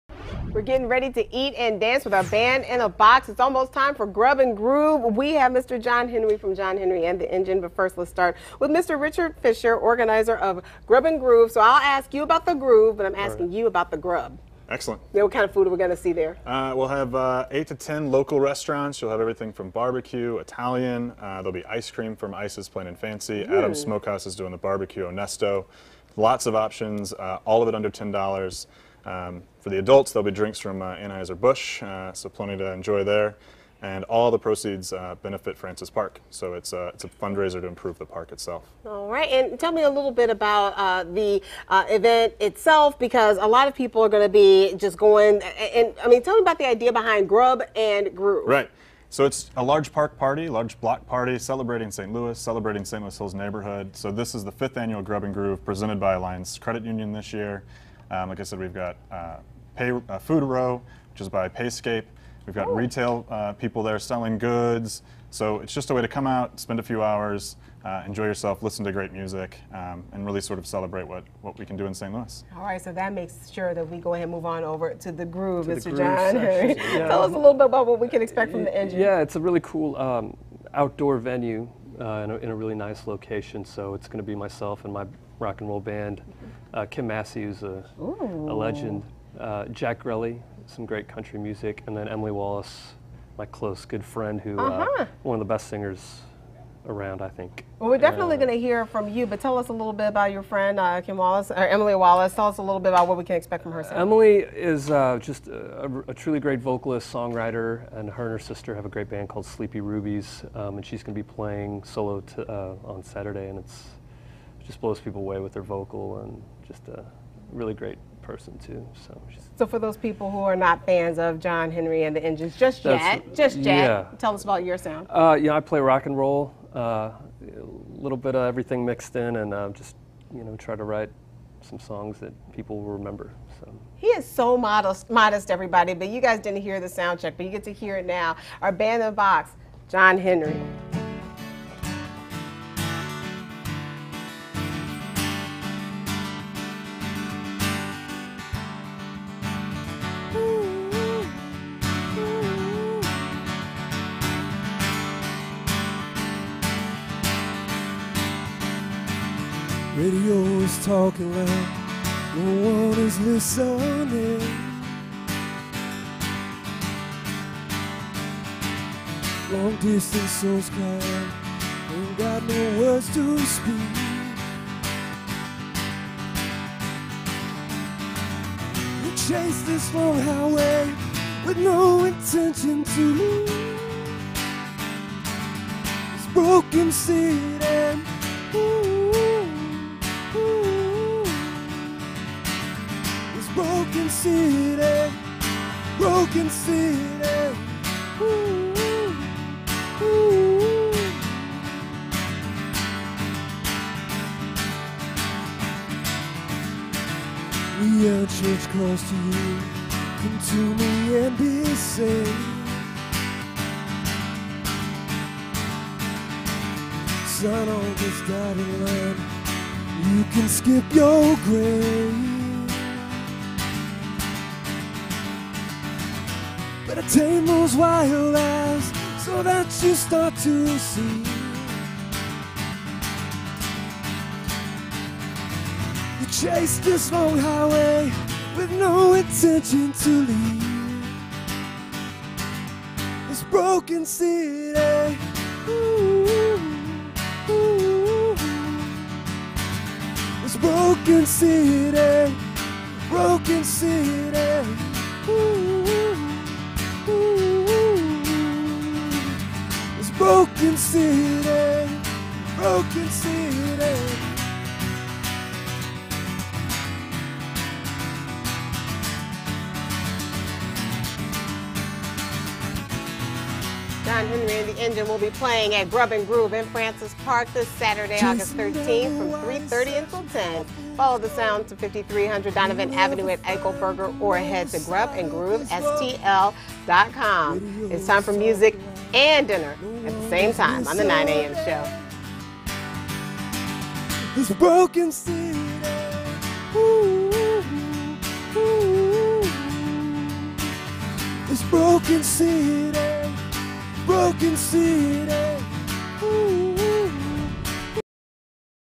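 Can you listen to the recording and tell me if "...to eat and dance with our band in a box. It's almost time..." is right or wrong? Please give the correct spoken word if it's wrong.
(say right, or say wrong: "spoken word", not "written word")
right.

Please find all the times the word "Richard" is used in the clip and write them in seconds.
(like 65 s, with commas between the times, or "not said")
8 s.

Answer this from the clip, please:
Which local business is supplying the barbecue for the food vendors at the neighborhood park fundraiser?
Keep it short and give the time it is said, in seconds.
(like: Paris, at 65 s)
Adam's Smokehouse, at 23 s.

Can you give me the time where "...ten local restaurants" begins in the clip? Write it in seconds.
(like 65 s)
17 s.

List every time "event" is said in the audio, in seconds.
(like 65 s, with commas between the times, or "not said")
41 s.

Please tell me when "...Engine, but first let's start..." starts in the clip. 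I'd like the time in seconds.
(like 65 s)
7 s.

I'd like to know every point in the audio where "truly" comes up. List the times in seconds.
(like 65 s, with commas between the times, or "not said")
106 s.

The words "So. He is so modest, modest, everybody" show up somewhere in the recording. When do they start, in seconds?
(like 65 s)
133 s.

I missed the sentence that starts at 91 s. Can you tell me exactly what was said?
And then Emily Wallace, my close good friend, who uh, -huh.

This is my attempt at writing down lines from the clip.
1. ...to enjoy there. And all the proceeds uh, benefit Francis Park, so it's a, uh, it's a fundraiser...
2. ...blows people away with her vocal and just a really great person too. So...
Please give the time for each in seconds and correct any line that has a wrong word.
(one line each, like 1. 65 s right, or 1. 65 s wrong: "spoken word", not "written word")
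1. 32 s right
2. 114 s right.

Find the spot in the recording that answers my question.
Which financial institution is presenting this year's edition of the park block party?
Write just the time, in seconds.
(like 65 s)
56 s.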